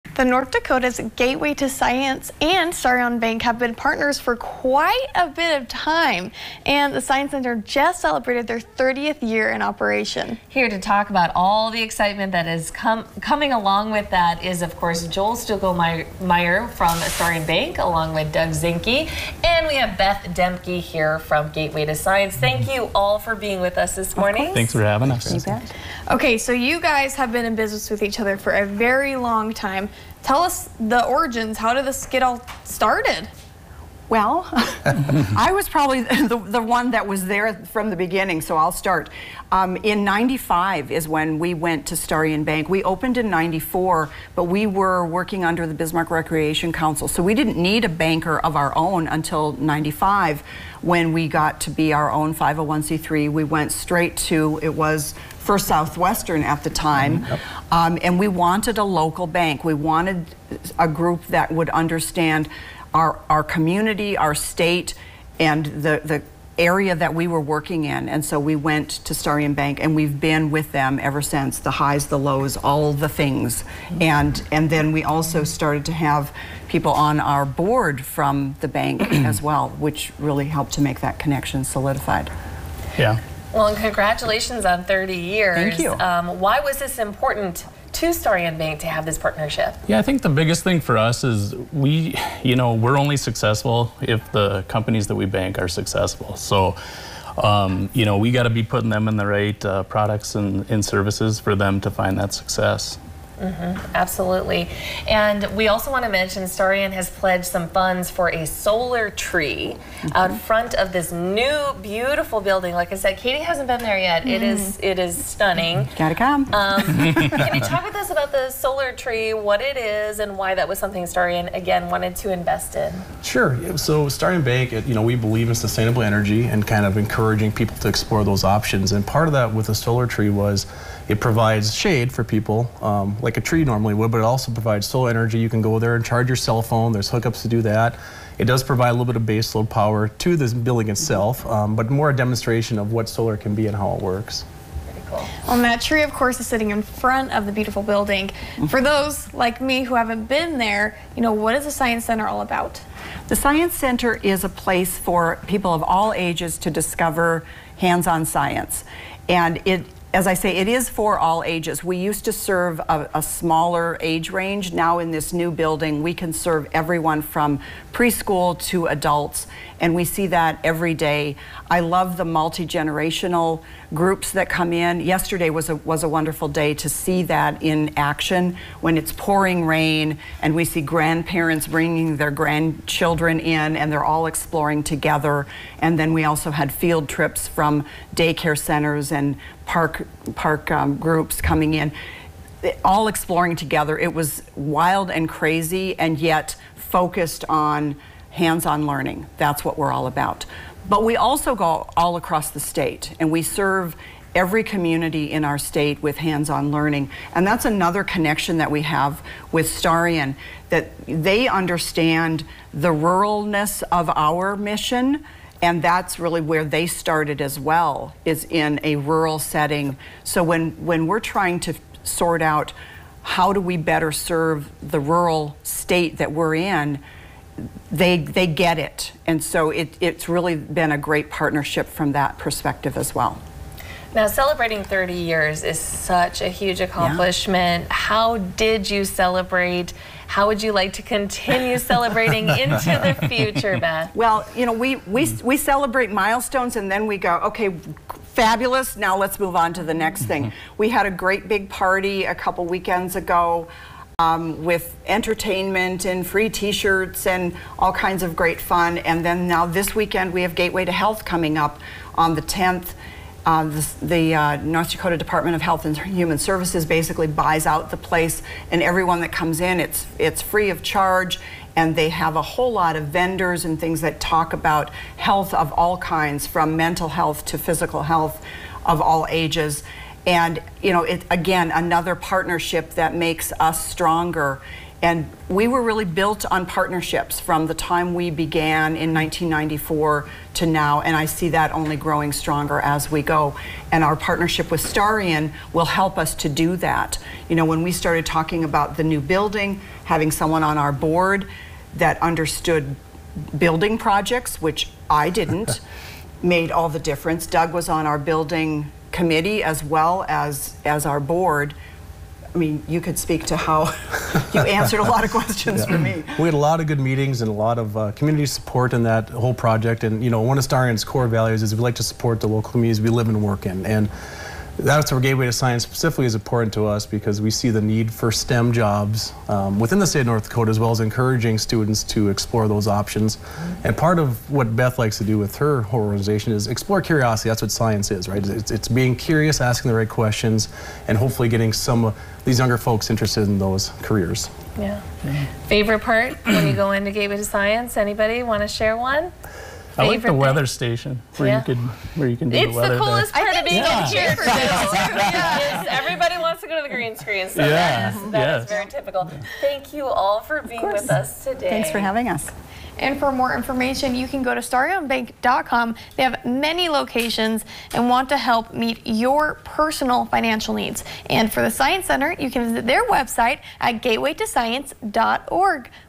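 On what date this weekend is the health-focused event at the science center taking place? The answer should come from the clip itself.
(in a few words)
the 10th.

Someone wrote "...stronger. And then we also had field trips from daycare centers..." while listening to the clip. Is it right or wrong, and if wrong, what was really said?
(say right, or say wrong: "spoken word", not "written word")
wrong: "together", not "stronger".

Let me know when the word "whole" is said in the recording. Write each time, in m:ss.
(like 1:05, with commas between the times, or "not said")
4:32, 5:19, 5:35.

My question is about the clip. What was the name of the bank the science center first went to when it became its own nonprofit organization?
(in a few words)
First Southwestern.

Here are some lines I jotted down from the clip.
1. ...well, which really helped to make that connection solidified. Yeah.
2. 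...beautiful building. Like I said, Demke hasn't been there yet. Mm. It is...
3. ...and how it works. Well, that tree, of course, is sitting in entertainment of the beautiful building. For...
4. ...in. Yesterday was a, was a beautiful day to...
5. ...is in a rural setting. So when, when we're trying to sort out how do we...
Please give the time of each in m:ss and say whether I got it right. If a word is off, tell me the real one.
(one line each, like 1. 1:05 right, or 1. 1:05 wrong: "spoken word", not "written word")
1. 1:19 right
2. 1:51 wrong: "Katie", not "Demke"
3. 2:23 wrong: "front", not "entertainment"
4. 2:54 wrong: "wonderful", not "beautiful"
5. 3:38 right.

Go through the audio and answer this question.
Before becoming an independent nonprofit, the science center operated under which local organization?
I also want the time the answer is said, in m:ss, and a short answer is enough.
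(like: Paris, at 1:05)
Bismarck Recreation Council, at 0:45.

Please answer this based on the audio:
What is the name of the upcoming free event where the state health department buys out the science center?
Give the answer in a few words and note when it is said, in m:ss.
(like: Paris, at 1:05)
Gateway to Health, at 4:20.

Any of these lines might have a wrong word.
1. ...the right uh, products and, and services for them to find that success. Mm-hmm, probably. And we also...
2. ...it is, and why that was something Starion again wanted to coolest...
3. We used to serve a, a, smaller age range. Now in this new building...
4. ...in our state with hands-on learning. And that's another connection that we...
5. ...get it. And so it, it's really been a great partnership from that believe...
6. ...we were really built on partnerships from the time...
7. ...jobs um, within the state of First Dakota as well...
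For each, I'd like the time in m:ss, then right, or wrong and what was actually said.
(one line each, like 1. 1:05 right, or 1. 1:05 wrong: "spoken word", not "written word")
1. 1:39 wrong: "absolutely", not "probably"
2. 1:59 wrong: "invest", not "coolest"
3. 2:41 right
4. 3:25 right
5. 3:48 wrong: "perspective", not "believe"
6. 4:45 right
7. 5:28 wrong: "North", not "First".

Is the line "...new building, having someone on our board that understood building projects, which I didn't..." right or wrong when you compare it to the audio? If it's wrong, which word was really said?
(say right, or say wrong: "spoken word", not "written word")
right.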